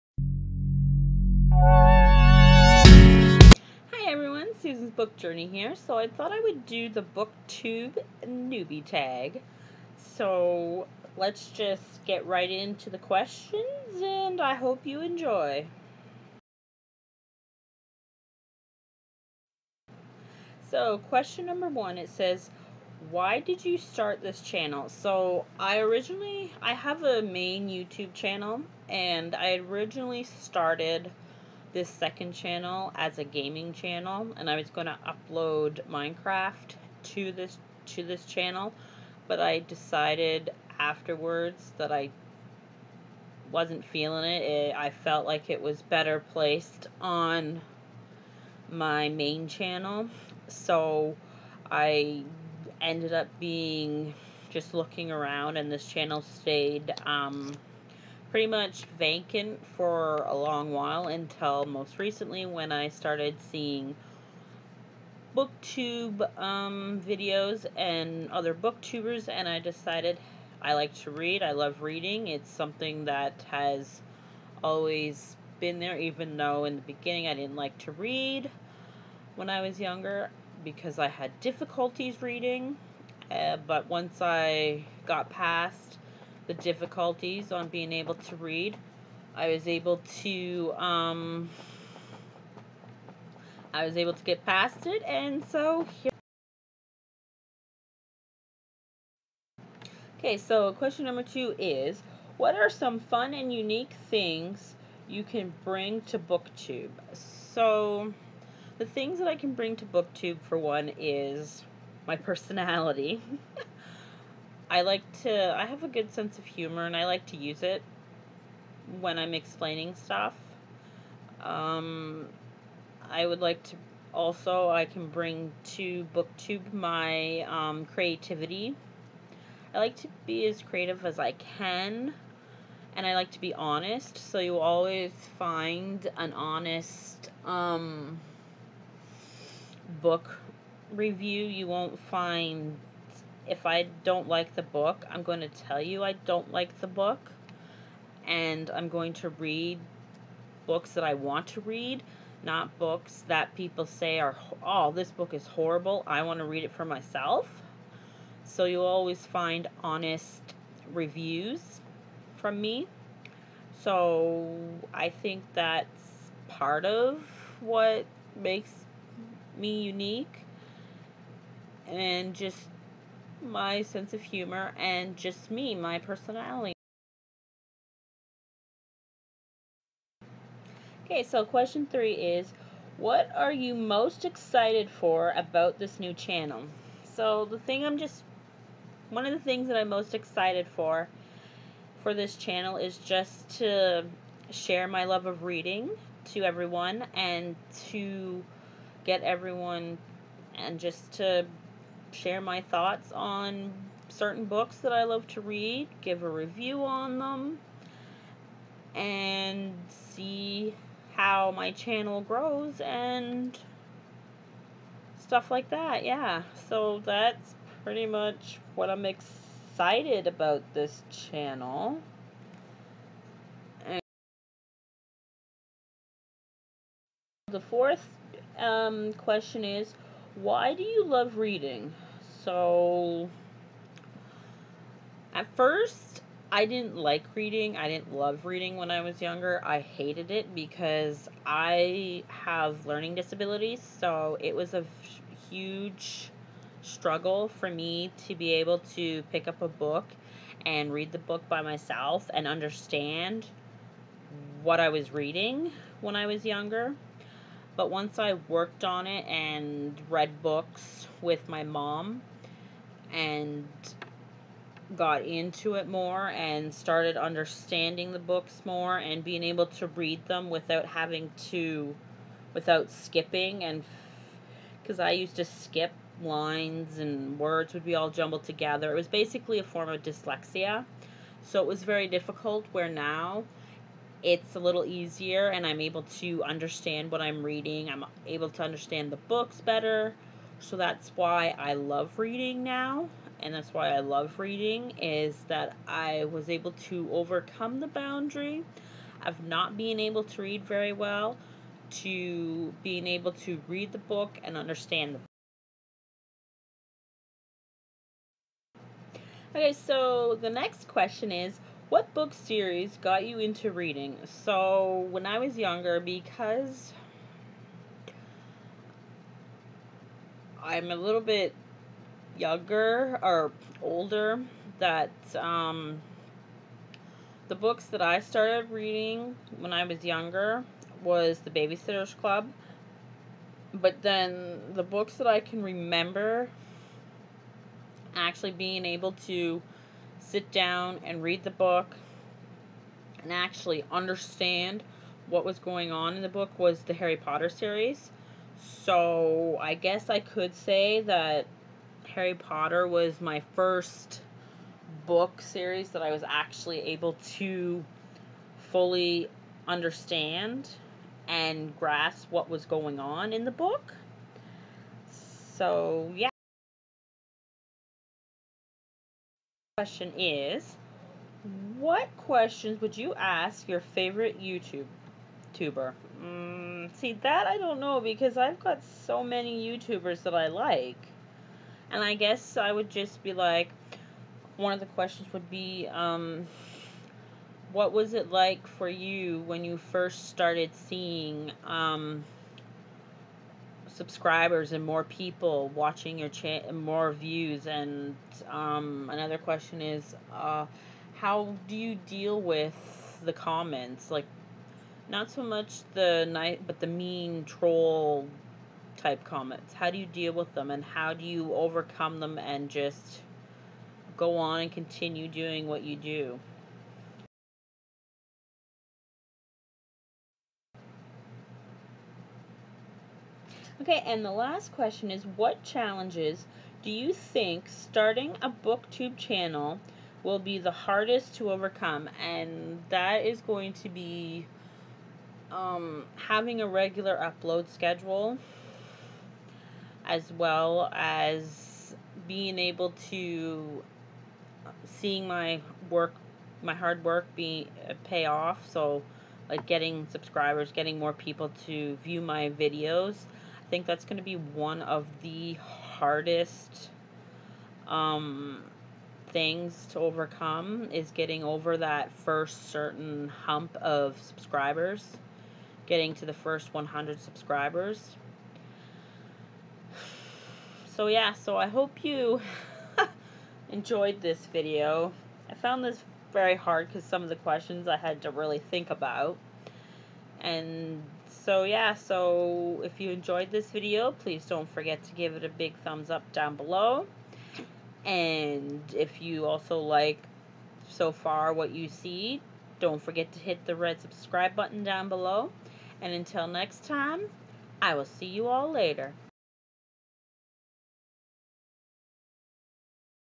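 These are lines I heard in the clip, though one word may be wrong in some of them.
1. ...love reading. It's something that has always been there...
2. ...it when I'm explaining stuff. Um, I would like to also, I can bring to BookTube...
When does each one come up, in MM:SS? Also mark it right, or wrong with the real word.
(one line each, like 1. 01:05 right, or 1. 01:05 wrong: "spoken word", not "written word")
1. 01:11 right
2. 01:57 right.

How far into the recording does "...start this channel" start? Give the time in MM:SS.
00:23.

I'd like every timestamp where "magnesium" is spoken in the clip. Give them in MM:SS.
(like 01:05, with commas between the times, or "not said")
not said.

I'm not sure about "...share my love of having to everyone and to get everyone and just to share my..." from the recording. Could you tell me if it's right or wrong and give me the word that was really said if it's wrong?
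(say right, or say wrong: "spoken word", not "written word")
wrong: "reading", not "having".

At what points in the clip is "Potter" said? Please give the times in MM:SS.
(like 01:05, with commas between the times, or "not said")
05:47, 05:52.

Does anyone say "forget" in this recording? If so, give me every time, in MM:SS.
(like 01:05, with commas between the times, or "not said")
08:04, 08:13.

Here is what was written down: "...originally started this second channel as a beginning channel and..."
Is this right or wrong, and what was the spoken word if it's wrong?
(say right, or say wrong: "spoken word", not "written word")
wrong: "gaming", not "beginning".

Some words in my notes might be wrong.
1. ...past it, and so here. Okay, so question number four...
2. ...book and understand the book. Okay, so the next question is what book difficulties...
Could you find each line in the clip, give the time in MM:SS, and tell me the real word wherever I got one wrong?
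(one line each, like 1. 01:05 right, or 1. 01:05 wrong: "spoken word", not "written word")
1. 01:34 wrong: "two", not "four"
2. 05:03 wrong: "series", not "difficulties".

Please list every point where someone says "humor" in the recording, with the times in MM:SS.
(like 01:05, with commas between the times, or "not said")
01:56, 02:54.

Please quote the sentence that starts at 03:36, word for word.
Yeah, so that's pretty much what I'm excited about this channel.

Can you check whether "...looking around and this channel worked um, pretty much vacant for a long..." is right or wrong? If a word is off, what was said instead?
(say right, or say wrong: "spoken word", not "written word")
wrong: "stayed", not "worked".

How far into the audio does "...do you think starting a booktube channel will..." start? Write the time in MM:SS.
07:06.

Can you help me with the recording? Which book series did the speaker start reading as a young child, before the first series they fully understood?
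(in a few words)
The Babysitter's Club.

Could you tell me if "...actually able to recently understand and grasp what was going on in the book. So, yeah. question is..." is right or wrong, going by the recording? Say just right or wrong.
wrong.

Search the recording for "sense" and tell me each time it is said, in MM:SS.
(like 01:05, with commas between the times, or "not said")
01:56, 02:53.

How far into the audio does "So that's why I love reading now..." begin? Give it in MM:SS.
04:50.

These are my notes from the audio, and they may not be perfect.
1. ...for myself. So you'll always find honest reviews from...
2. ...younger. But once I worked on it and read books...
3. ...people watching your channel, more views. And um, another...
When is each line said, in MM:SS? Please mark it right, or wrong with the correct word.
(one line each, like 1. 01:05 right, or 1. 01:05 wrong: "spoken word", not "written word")
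1. 02:36 right
2. 04:16 right
3. 06:35 right.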